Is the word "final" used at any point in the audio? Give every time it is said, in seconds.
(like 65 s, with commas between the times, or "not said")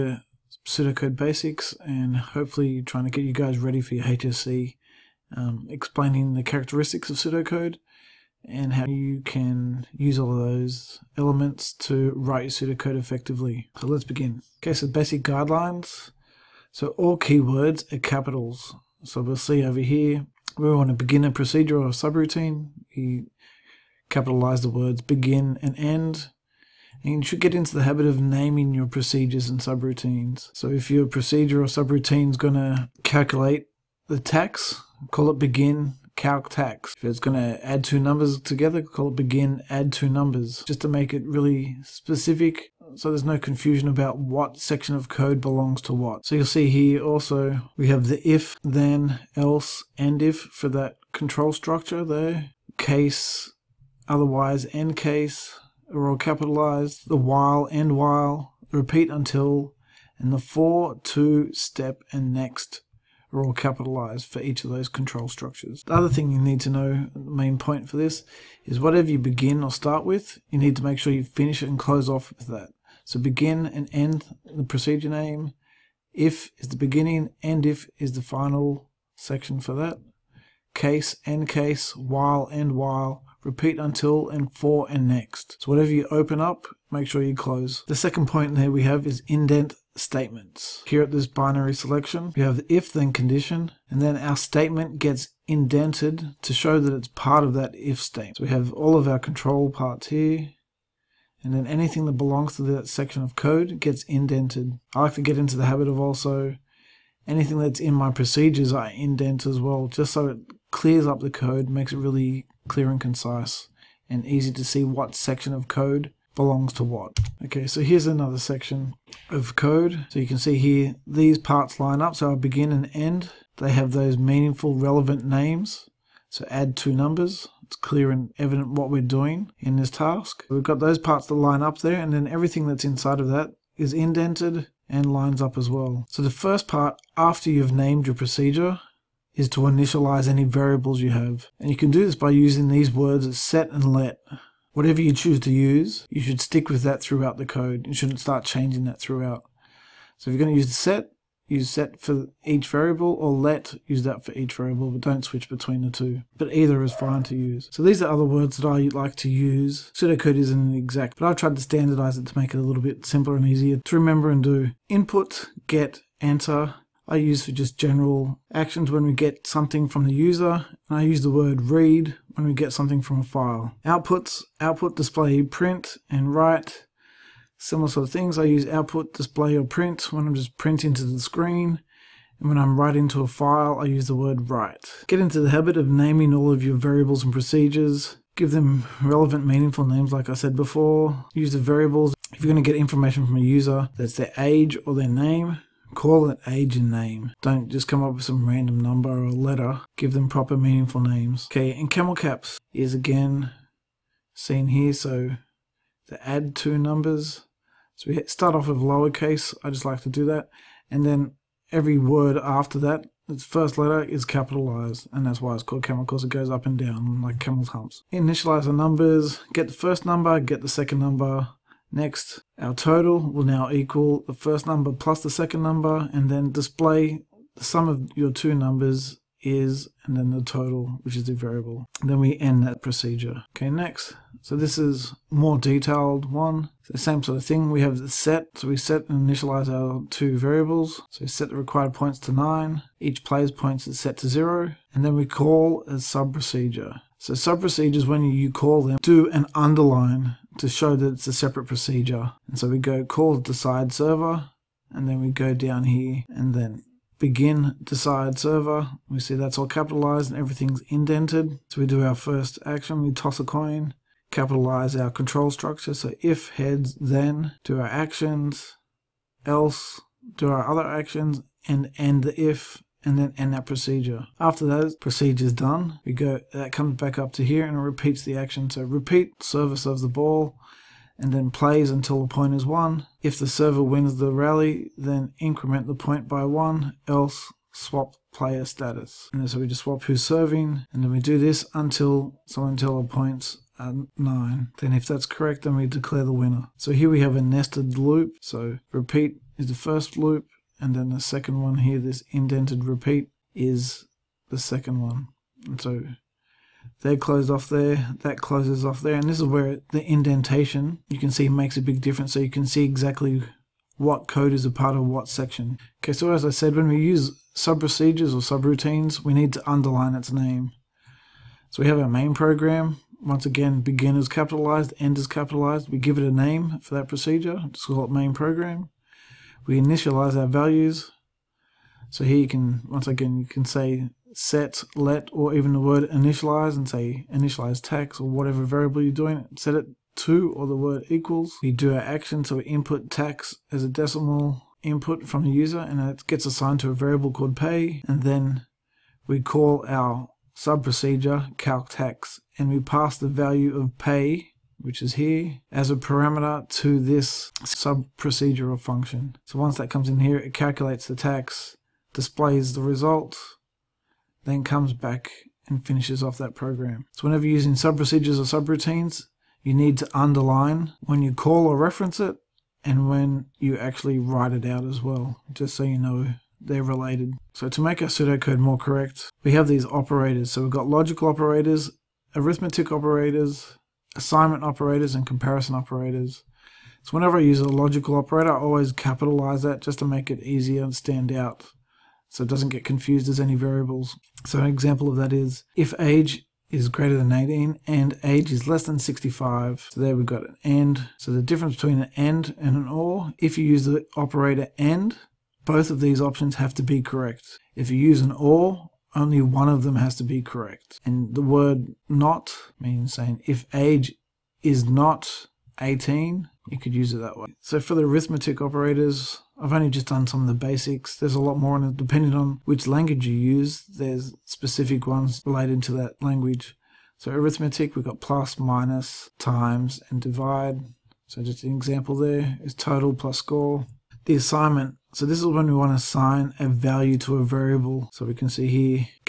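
78 s.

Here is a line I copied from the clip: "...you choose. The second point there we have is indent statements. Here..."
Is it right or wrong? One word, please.
wrong.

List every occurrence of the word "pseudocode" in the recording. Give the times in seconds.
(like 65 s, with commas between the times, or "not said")
0 s, 7 s, 12 s, 159 s, 378 s.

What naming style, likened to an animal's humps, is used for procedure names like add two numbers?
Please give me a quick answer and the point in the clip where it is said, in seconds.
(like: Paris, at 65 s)
camel caps, at 201 s.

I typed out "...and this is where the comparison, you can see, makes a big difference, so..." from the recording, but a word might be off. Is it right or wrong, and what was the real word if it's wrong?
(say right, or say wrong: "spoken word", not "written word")
wrong: "indentation", not "comparison".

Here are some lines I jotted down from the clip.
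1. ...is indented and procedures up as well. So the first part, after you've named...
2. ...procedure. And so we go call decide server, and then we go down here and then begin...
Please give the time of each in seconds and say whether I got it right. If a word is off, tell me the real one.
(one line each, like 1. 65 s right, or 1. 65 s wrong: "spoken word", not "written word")
1. 133 s wrong: "lines", not "procedures"
2. 251 s right.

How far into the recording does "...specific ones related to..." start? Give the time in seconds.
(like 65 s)
424 s.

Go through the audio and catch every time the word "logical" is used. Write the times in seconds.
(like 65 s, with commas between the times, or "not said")
380 s, 387 s.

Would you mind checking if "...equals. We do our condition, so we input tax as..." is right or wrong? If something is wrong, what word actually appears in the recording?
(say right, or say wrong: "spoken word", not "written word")
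wrong: "action", not "condition".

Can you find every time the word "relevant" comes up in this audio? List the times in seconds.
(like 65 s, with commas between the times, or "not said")
124 s, 189 s.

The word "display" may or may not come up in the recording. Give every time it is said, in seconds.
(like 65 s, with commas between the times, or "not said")
174 s, 179 s, 226 s, 362 s.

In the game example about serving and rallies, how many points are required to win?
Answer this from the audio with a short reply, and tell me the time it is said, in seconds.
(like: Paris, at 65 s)
9, at 241 s.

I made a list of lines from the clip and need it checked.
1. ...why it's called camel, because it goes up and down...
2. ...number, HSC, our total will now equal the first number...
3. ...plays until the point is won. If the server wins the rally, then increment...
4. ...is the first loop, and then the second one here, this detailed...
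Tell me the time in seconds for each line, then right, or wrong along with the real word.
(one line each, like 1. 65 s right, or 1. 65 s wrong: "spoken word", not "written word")
1. 215 s right
2. 220 s wrong: "Next", not "HSC"
3. 281 s right
4. 299 s wrong: "indented", not "detailed".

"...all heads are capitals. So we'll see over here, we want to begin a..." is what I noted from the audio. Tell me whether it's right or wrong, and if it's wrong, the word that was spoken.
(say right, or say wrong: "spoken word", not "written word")
wrong: "keywords", not "heads".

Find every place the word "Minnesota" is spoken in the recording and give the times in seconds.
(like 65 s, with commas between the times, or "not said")
not said.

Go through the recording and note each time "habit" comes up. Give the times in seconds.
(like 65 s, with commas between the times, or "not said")
27 s, 105 s, 185 s.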